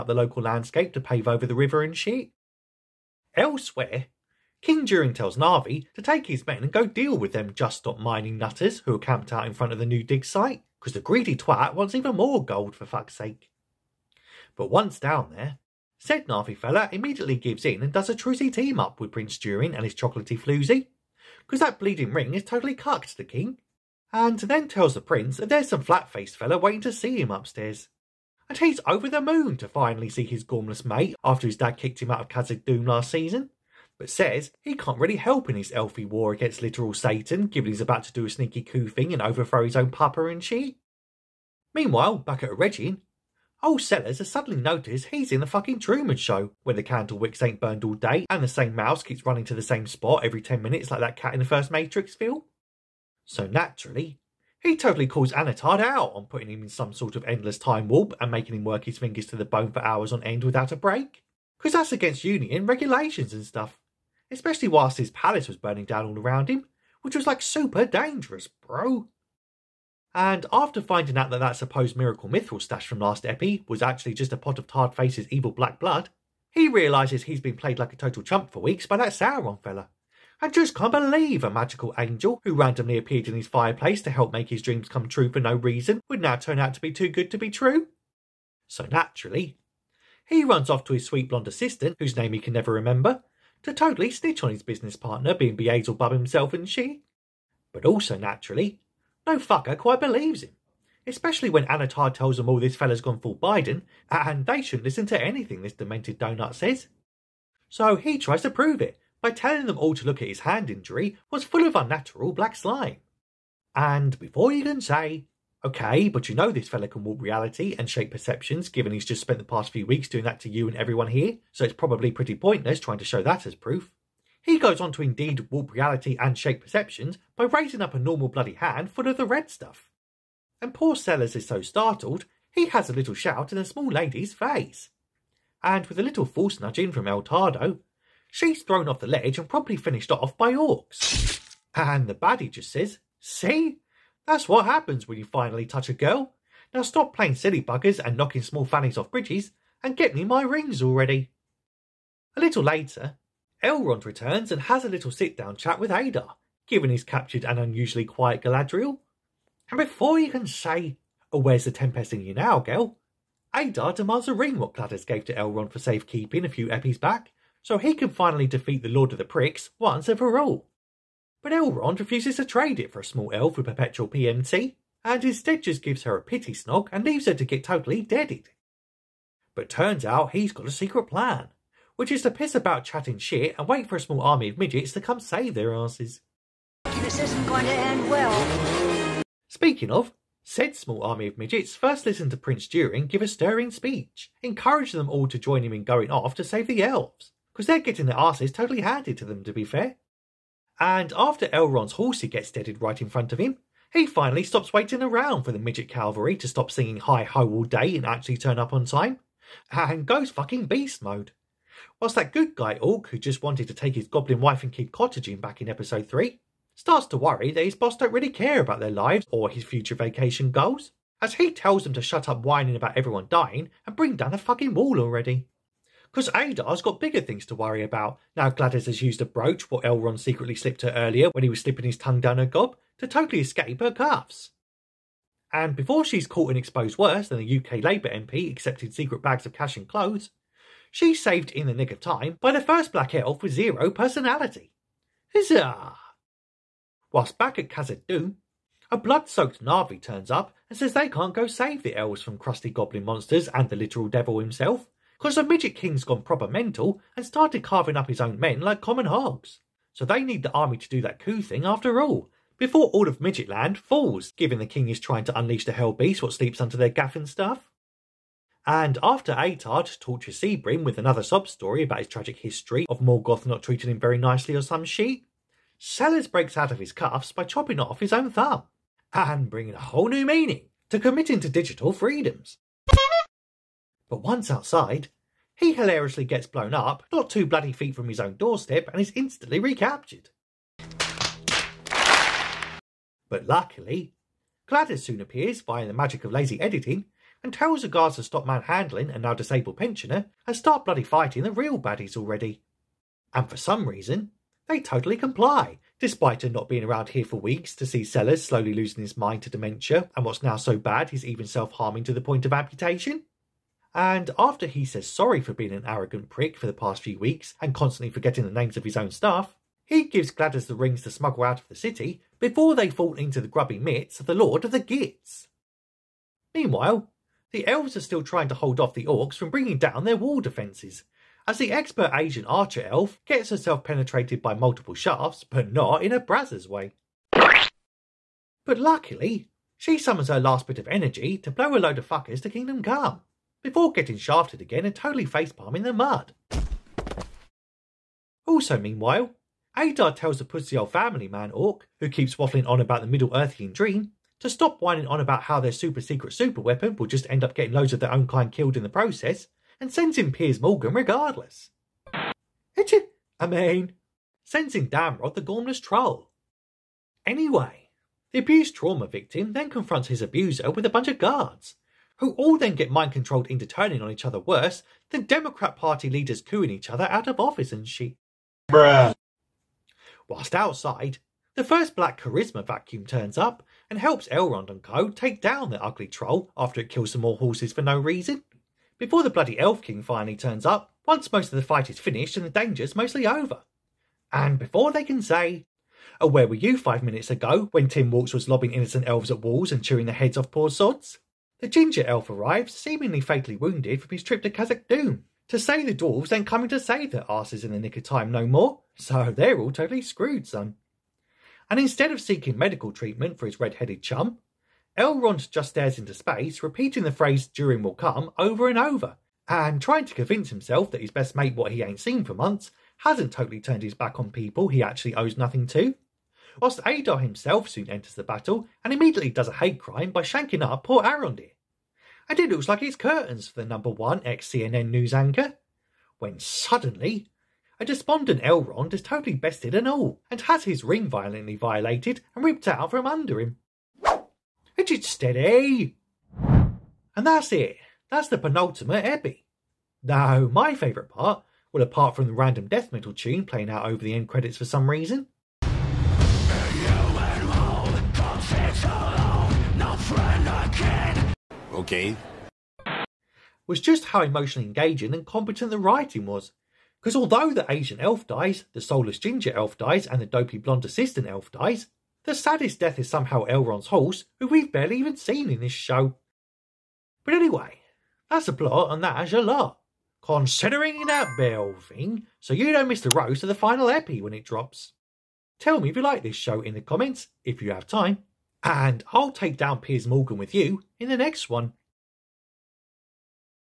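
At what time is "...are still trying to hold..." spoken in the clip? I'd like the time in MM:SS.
05:27.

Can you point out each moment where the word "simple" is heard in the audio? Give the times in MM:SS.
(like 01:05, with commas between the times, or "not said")
not said.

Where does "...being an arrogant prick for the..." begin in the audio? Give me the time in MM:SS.
05:15.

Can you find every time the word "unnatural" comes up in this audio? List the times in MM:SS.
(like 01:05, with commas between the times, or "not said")
01:51.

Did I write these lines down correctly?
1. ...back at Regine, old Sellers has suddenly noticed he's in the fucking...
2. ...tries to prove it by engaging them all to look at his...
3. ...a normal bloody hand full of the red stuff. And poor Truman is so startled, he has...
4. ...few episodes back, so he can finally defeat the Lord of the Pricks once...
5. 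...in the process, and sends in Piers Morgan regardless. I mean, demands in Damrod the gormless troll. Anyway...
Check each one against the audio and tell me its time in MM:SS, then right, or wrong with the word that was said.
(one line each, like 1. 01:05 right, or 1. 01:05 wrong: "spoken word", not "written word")
1. 00:42 right
2. 01:48 wrong: "telling", not "engaging"
3. 02:07 wrong: "Sellers", not "Truman"
4. 02:46 right
5. 05:58 wrong: "sends", not "demands".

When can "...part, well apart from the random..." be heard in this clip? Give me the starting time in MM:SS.
07:31.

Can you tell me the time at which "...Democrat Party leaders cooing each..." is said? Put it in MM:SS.
06:15.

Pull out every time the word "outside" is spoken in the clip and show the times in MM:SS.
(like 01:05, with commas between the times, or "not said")
04:44, 06:20.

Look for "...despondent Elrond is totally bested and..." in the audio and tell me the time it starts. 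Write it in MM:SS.
07:17.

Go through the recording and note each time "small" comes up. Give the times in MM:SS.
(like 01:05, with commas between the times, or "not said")
02:13, 02:28, 02:53, 03:04, 03:10.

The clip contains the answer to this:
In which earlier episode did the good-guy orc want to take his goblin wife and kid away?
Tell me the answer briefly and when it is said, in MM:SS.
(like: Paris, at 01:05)
Episode 3, at 03:35.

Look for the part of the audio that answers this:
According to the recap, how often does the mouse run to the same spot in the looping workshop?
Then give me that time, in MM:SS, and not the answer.
00:50.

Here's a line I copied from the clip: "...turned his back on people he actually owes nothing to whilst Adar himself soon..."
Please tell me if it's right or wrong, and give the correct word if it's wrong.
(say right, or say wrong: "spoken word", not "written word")
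right.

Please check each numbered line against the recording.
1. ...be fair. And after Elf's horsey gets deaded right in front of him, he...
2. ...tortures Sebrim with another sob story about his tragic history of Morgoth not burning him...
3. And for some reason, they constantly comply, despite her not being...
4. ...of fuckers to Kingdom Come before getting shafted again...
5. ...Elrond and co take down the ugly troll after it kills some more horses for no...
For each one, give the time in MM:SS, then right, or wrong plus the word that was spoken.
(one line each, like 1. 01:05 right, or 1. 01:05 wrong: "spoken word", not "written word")
1. 03:19 wrong: "Elrond", not "Elf"
2. 04:29 wrong: "treating", not "burning"
3. 05:03 wrong: "totally", not "constantly"
4. 05:41 right
5. 06:24 right.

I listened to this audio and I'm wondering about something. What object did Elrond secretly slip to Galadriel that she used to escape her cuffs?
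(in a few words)
A brooch.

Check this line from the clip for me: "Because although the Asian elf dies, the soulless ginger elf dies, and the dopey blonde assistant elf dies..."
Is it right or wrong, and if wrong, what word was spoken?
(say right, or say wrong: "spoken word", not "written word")
right.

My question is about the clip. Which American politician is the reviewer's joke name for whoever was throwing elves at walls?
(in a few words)
Tim Walz.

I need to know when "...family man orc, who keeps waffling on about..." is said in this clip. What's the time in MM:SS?
05:50.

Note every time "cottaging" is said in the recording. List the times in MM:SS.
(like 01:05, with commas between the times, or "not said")
03:34.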